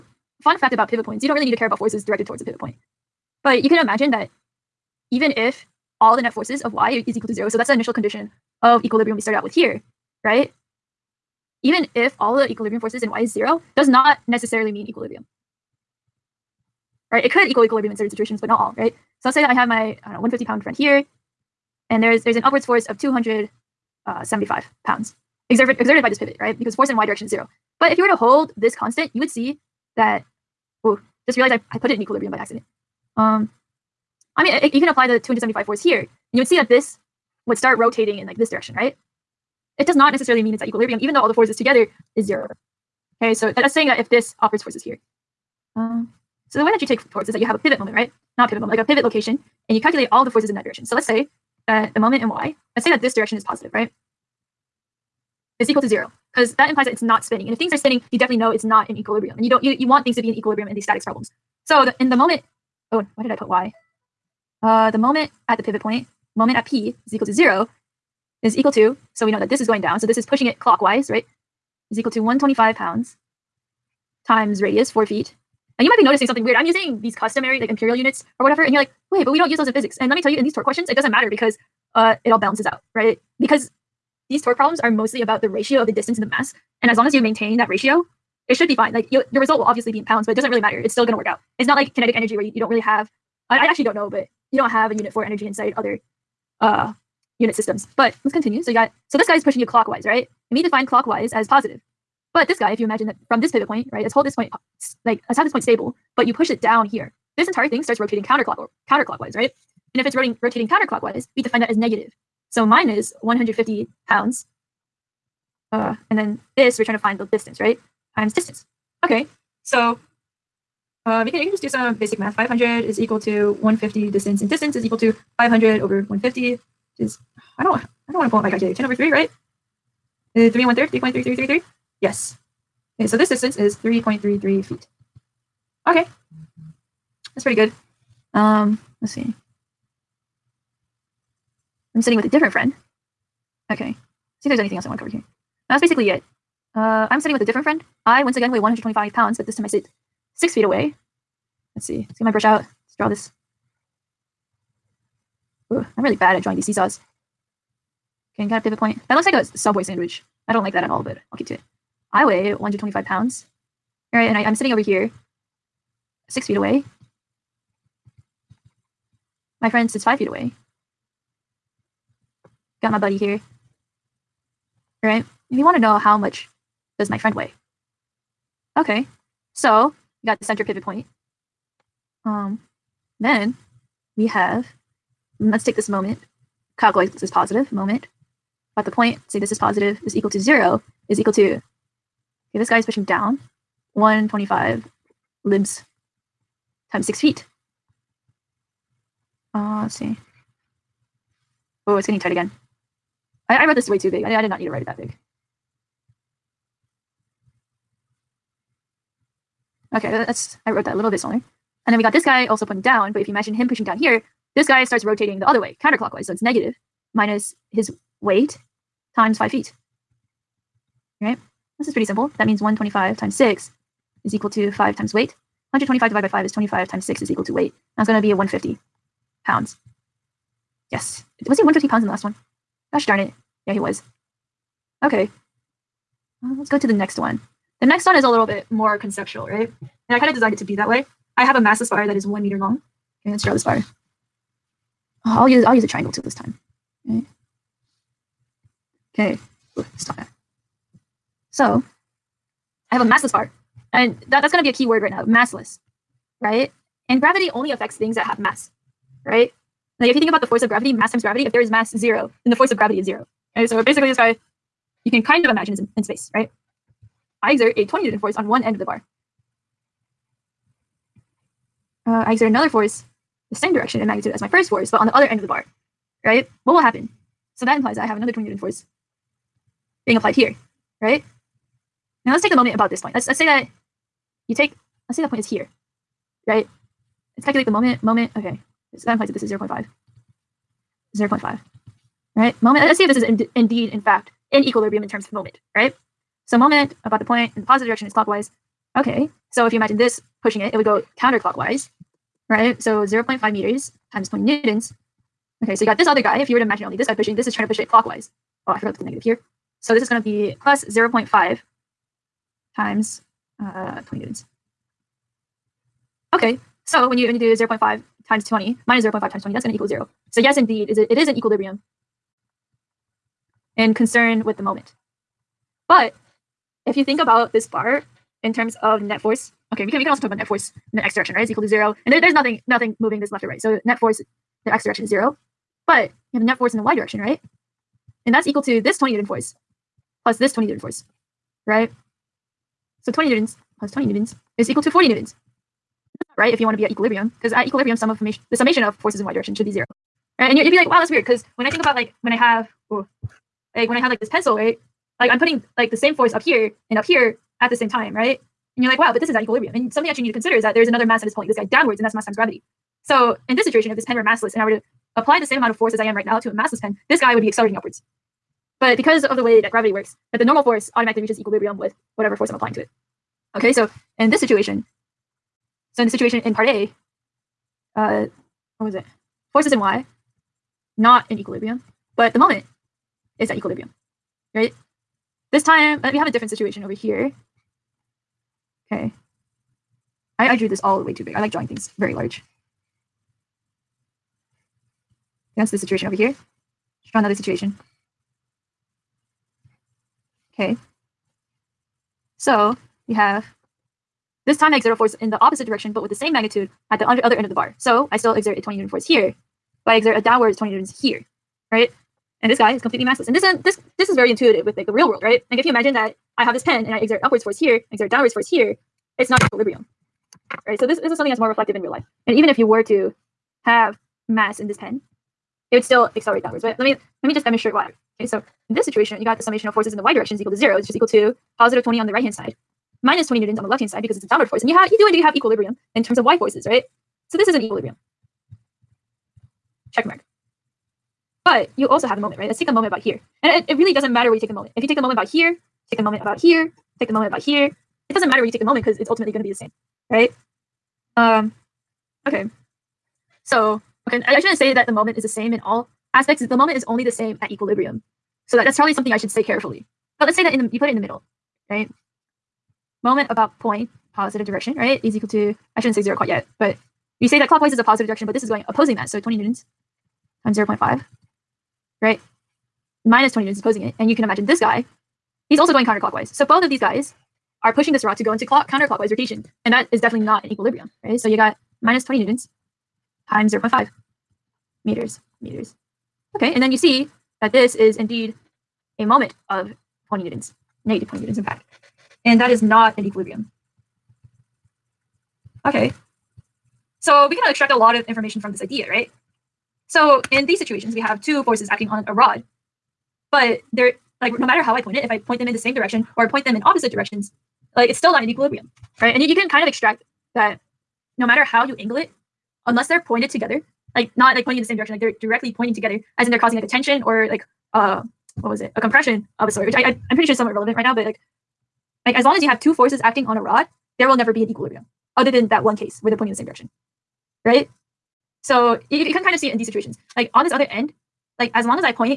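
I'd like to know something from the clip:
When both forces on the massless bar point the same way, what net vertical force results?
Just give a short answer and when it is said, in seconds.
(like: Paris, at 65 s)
40 newtons, at 344 s.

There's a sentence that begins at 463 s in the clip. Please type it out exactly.
Moment about point, positive direction, right?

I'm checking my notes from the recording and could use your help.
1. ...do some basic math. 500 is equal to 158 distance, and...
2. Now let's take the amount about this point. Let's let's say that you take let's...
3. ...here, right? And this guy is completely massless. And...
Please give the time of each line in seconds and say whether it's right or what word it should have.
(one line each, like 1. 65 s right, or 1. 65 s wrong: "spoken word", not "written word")
1. 121 s wrong: "150", not "158"
2. 282 s wrong: "moment", not "amount"
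3. 411 s right.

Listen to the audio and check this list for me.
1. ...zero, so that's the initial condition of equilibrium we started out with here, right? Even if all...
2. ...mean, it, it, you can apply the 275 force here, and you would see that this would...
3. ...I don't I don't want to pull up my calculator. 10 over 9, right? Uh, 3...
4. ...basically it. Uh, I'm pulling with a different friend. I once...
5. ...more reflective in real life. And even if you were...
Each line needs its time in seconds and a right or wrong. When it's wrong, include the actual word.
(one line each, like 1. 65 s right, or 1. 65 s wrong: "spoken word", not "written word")
1. 7 s right
2. 34 s right
3. 127 s wrong: "3", not "9"
4. 145 s wrong: "sitting", not "pulling"
5. 421 s right.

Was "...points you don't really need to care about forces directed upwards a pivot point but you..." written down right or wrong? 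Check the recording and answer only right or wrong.
wrong.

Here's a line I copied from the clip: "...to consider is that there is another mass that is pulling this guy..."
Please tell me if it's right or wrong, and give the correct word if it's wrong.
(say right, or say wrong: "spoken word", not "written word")
right.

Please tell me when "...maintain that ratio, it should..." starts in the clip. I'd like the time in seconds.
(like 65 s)
87 s.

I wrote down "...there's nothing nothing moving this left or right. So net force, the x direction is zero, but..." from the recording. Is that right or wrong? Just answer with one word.
right.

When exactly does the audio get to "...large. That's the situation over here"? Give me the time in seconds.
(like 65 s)
392 s.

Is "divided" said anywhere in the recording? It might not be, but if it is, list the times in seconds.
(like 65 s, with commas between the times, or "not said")
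226 s.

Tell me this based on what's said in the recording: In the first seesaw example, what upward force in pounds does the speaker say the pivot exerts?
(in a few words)
275 pounds.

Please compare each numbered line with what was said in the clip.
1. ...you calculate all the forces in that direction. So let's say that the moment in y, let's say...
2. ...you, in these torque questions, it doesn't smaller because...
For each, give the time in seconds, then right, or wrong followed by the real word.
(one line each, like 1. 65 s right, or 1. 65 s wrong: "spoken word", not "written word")
1. 49 s right
2. 80 s wrong: "matter", not "smaller".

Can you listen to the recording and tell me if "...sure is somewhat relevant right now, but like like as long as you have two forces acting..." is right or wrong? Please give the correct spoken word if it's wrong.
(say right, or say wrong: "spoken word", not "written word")
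right.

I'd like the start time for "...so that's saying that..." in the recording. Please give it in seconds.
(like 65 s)
43 s.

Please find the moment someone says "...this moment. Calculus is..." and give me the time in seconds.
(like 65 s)
185 s.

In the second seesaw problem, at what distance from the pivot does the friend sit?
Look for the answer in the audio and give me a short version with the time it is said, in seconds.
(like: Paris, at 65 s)
5 feet, at 170 s.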